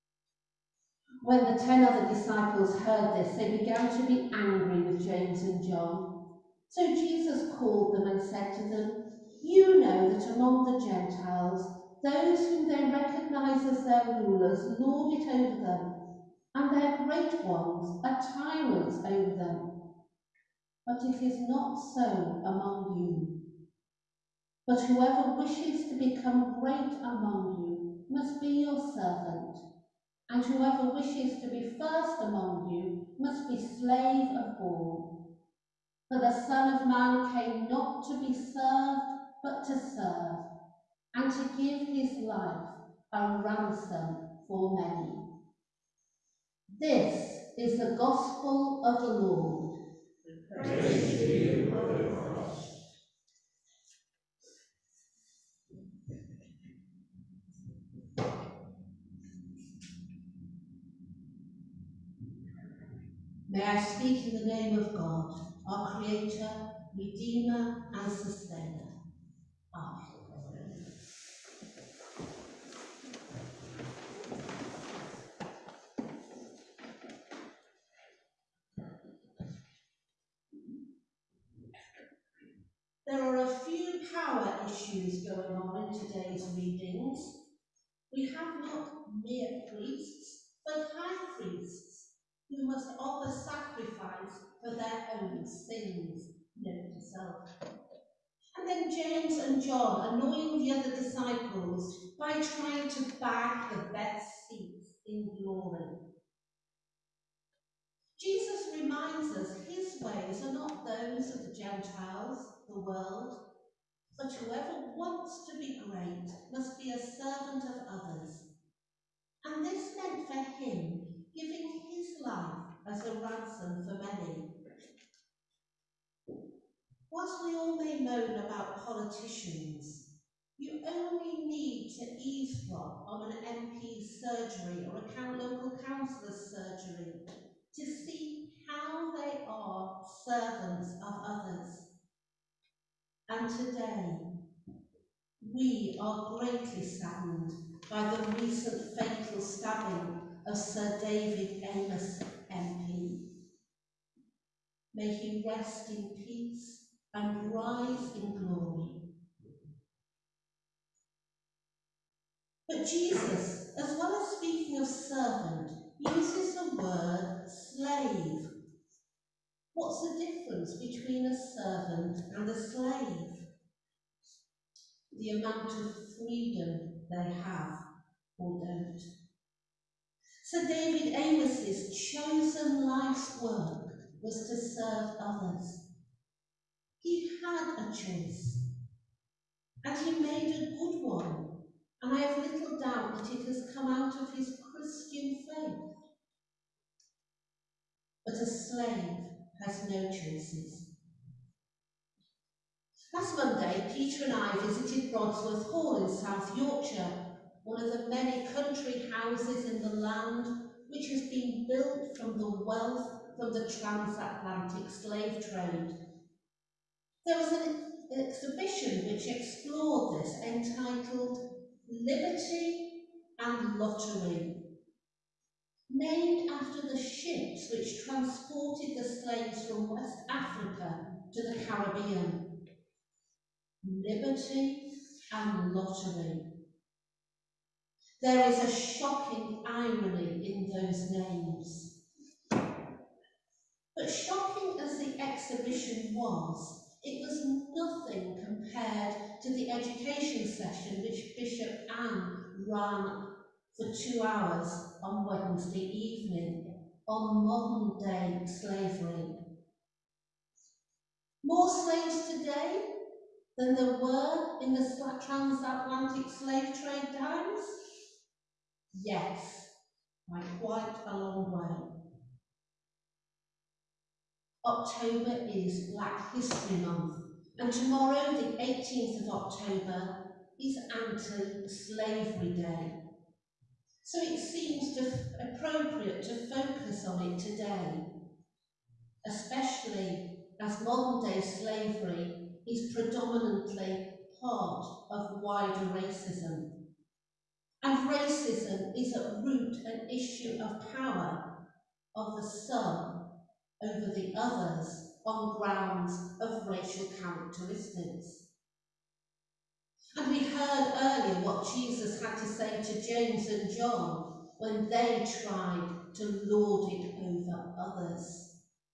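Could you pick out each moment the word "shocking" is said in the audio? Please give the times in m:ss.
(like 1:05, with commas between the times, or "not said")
3:58, 4:04.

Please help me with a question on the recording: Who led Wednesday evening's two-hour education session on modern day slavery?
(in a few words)
Bishop Anne.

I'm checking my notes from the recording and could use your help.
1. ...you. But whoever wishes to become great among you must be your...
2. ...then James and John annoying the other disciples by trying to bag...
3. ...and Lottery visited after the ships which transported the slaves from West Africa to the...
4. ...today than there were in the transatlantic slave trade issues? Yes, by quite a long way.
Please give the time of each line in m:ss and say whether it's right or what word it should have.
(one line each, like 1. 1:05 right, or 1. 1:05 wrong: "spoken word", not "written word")
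1. 0:22 right
2. 1:38 right
3. 3:43 wrong: "named", not "visited"
4. 4:22 wrong: "times", not "issues".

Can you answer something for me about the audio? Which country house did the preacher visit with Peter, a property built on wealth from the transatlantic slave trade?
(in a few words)
Brodsworth Hall.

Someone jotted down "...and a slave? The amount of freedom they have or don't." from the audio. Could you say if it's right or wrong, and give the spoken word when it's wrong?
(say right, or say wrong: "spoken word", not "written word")
right.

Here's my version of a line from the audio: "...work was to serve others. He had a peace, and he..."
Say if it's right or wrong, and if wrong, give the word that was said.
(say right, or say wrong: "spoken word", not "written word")
wrong: "choice", not "peace".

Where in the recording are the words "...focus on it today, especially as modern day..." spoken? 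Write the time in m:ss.
4:46.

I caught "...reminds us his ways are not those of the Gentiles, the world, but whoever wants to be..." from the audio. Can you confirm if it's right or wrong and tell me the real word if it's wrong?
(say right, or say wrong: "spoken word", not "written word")
right.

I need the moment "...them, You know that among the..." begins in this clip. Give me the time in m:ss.
0:08.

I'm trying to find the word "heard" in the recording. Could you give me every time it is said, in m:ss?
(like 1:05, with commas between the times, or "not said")
0:02, 5:10.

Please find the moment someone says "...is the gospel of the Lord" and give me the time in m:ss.
0:47.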